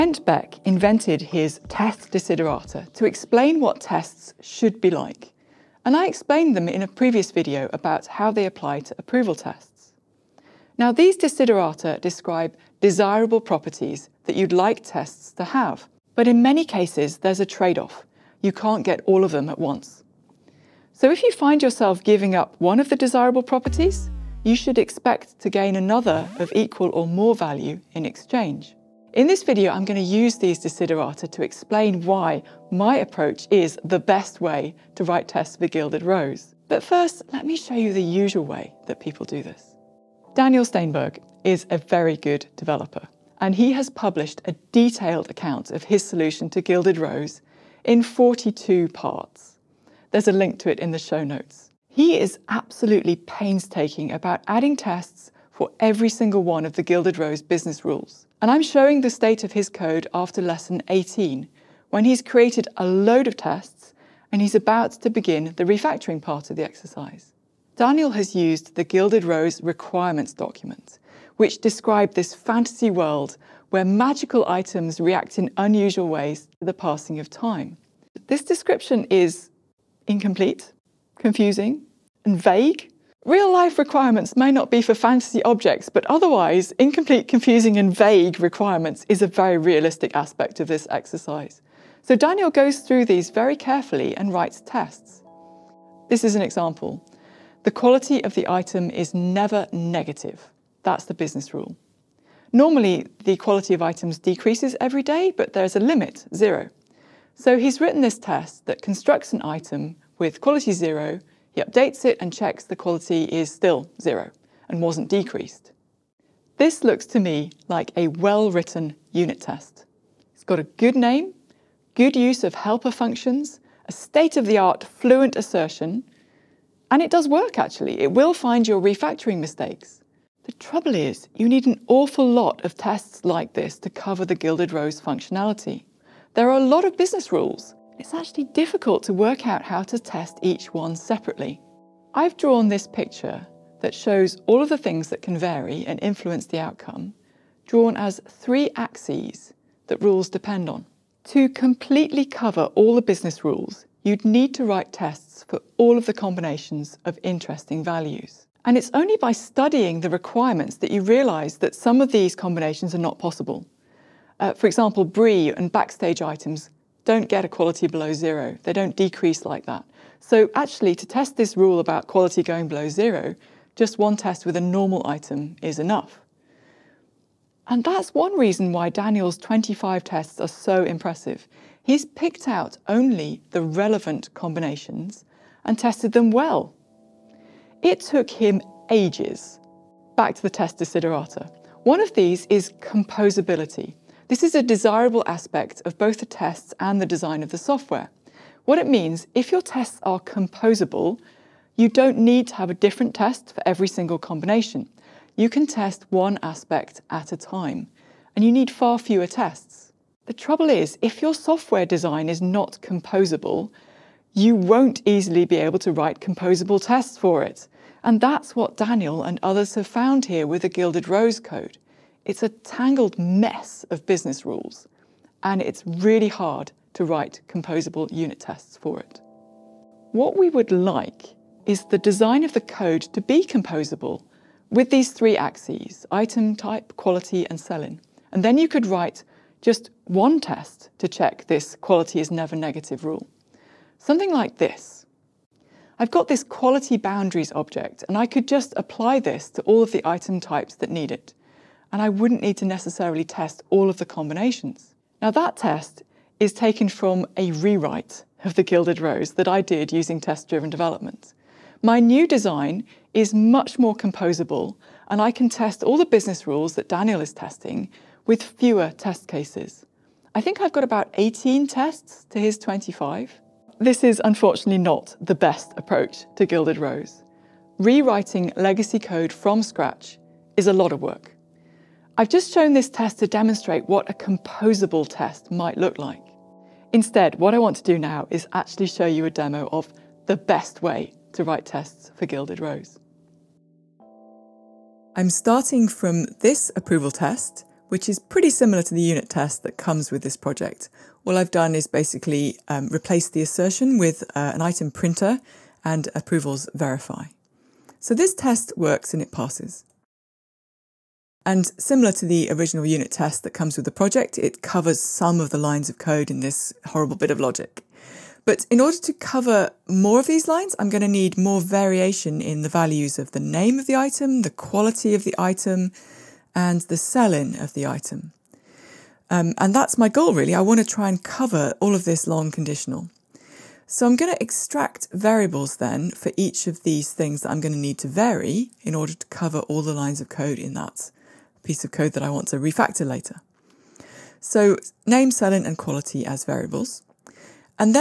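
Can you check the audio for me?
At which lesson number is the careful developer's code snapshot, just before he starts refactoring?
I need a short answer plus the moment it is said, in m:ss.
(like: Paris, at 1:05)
18, at 1:00.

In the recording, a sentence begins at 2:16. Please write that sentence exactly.
There are a lot of business rules.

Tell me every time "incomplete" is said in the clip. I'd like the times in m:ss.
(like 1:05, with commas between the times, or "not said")
1:20, 1:26.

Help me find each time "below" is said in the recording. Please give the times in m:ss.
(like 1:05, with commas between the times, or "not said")
2:47, 2:52.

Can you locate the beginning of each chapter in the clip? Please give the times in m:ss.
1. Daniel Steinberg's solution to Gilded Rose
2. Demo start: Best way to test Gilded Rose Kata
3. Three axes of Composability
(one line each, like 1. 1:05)
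1. 0:39
2. 4:53
3. 2:20.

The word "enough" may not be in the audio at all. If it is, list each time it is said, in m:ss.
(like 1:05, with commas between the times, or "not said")
2:55.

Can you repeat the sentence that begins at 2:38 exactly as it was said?
And it's only by studying the requirements that you realize that some of these combinations are not possible.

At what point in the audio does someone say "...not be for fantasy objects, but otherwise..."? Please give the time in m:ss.
1:24.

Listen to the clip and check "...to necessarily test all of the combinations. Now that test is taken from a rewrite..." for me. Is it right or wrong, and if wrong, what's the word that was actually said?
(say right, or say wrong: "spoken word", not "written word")
right.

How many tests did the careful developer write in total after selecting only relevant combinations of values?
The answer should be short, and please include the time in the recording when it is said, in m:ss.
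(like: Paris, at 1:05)
25, at 2:59.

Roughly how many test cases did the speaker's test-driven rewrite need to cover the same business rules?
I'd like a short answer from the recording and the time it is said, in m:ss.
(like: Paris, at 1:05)
18, at 4:31.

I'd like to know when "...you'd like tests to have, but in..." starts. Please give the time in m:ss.
0:14.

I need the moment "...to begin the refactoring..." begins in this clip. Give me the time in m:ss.
1:05.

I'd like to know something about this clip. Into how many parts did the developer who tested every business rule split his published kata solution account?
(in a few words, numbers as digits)
42.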